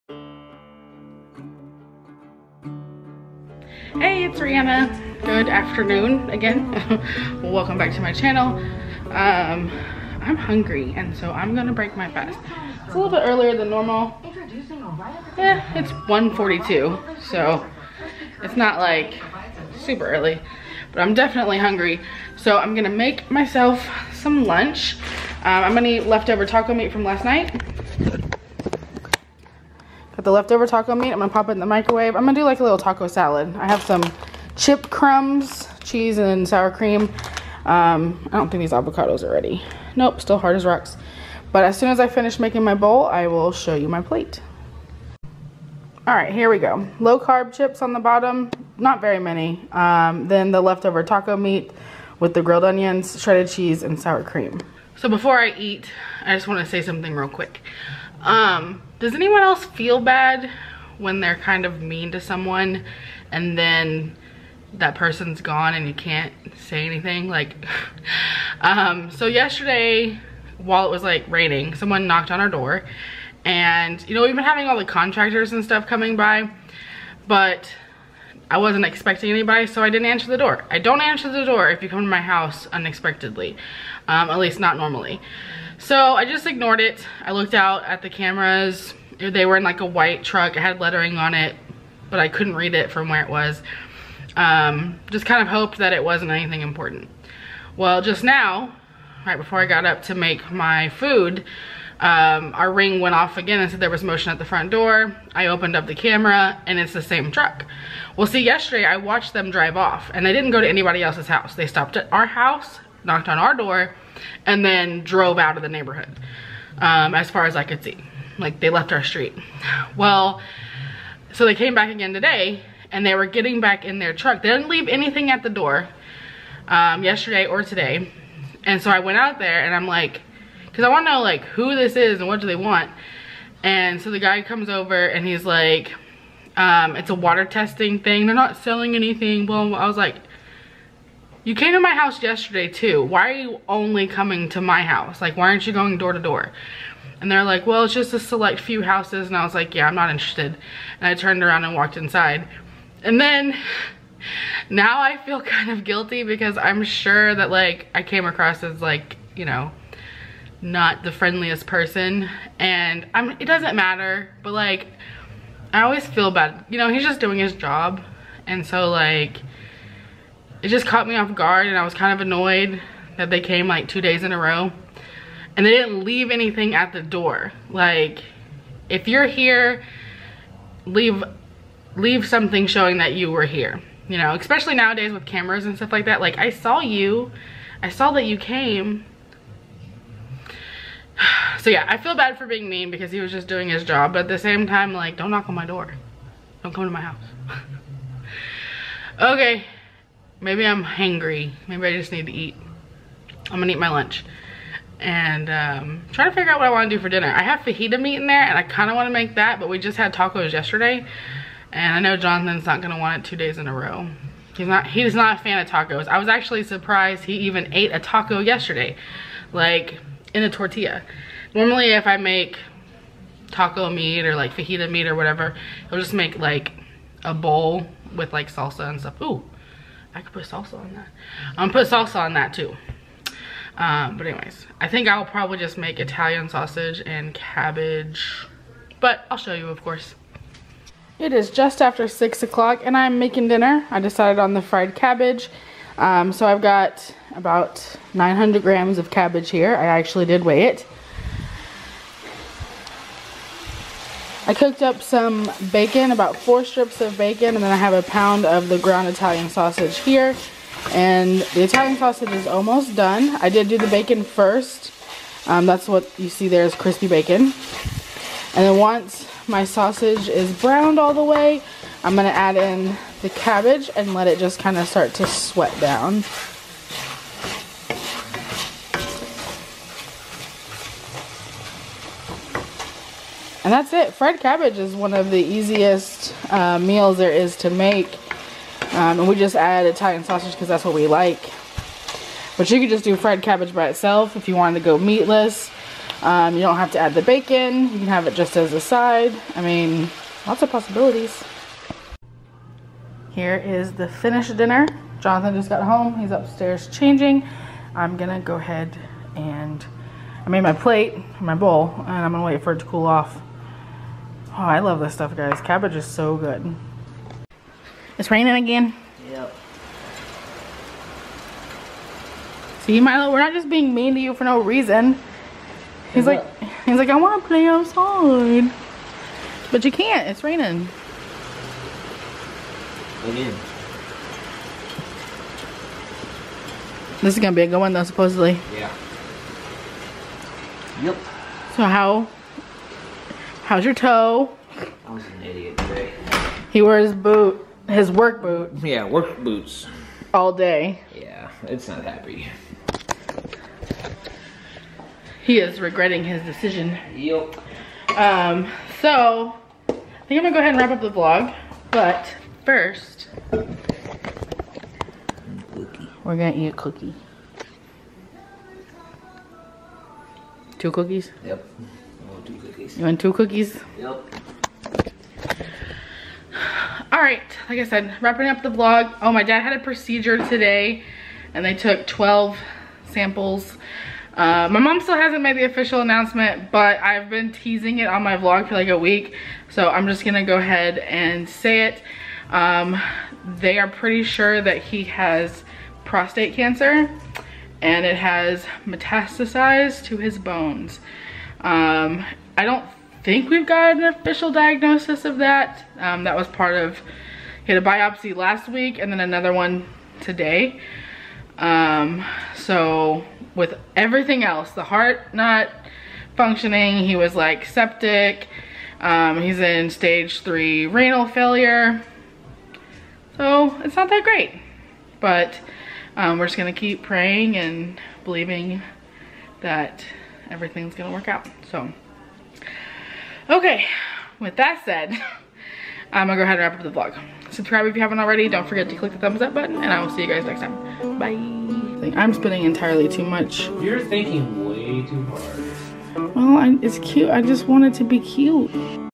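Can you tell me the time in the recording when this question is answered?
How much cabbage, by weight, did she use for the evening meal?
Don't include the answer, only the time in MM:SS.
04:08.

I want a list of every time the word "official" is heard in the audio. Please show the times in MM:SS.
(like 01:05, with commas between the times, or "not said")
06:25, 06:44.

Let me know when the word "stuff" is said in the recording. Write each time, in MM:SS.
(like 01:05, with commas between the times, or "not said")
01:15, 03:05, 03:48, 05:15.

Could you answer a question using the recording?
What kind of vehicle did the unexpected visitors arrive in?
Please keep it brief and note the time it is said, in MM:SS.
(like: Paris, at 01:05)
white truck, at 01:29.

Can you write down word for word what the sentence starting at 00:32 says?
I'm gonna do like a little taco salad.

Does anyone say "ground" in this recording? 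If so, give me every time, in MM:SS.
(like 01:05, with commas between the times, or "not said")
04:18.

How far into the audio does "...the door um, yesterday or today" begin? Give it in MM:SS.
02:05.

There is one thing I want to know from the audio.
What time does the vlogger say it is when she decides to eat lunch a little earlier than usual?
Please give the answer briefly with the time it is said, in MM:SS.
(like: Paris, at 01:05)
1.42, at 00:16.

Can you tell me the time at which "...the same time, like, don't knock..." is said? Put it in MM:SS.
03:14.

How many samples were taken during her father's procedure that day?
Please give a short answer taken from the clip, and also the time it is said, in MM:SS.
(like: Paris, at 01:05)
12, at 06:22.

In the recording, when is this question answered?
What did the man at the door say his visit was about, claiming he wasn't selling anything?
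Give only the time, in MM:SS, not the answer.
02:17.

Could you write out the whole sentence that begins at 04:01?
It is just after six o'clock and I'm making dinner.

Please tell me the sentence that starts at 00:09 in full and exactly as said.
Um, I'm hungry and so I'm gonna break my fast.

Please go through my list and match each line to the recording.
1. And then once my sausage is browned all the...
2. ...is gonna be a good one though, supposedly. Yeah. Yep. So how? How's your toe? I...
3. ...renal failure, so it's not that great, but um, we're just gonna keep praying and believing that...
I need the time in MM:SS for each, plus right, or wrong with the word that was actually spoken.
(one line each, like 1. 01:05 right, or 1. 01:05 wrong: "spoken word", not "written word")
1. 04:28 right
2. 05:37 right
3. 07:00 right.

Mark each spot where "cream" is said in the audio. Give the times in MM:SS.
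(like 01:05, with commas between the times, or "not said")
00:36, 00:54.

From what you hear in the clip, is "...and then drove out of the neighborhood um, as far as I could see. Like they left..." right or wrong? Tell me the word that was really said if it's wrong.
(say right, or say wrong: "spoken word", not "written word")
right.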